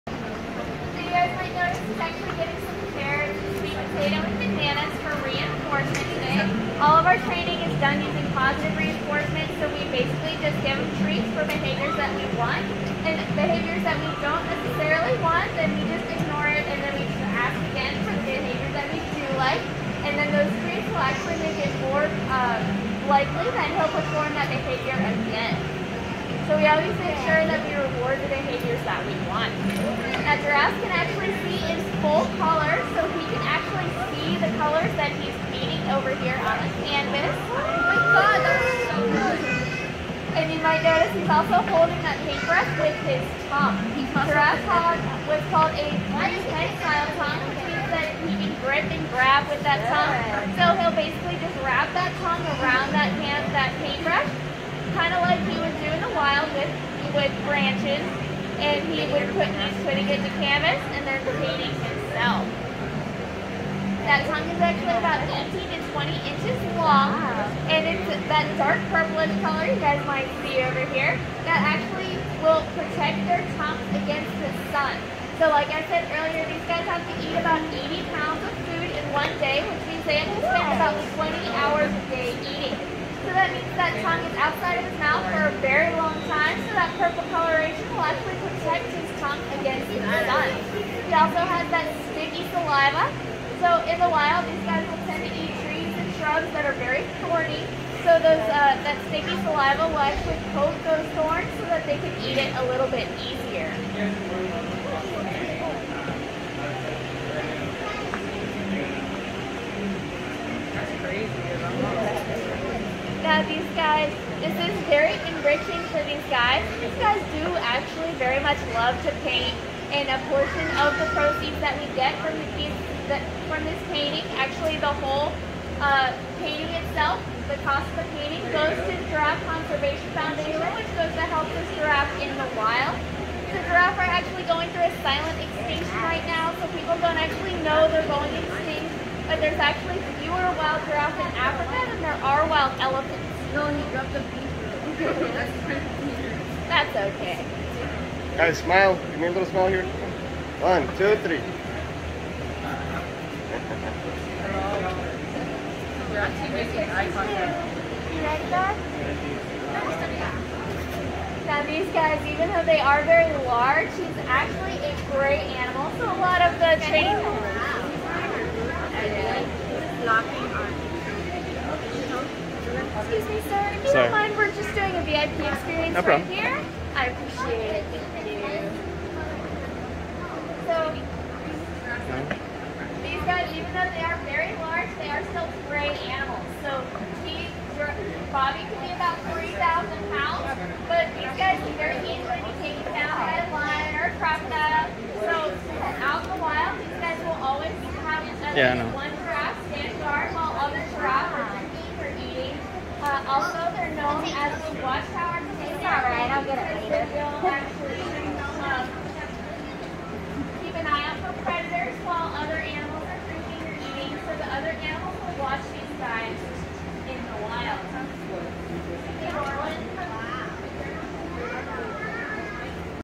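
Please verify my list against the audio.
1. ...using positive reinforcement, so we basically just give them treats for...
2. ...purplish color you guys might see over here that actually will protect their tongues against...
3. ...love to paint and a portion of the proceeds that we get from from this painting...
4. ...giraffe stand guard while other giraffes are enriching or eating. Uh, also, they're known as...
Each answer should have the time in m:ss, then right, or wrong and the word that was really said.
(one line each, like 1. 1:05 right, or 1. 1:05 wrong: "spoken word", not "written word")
1. 0:07 right
2. 1:08 right
3. 1:58 right
4. 3:19 wrong: "drinking", not "enriching".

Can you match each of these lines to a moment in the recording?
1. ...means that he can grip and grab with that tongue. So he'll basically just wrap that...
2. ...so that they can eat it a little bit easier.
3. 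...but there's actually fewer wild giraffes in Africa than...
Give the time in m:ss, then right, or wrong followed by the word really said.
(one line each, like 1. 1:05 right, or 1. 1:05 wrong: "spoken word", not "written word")
1. 0:47 right
2. 1:41 right
3. 2:19 right.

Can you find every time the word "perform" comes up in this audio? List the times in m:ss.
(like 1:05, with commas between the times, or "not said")
0:23.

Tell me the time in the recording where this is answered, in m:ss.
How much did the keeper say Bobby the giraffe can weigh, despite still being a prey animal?
3:09.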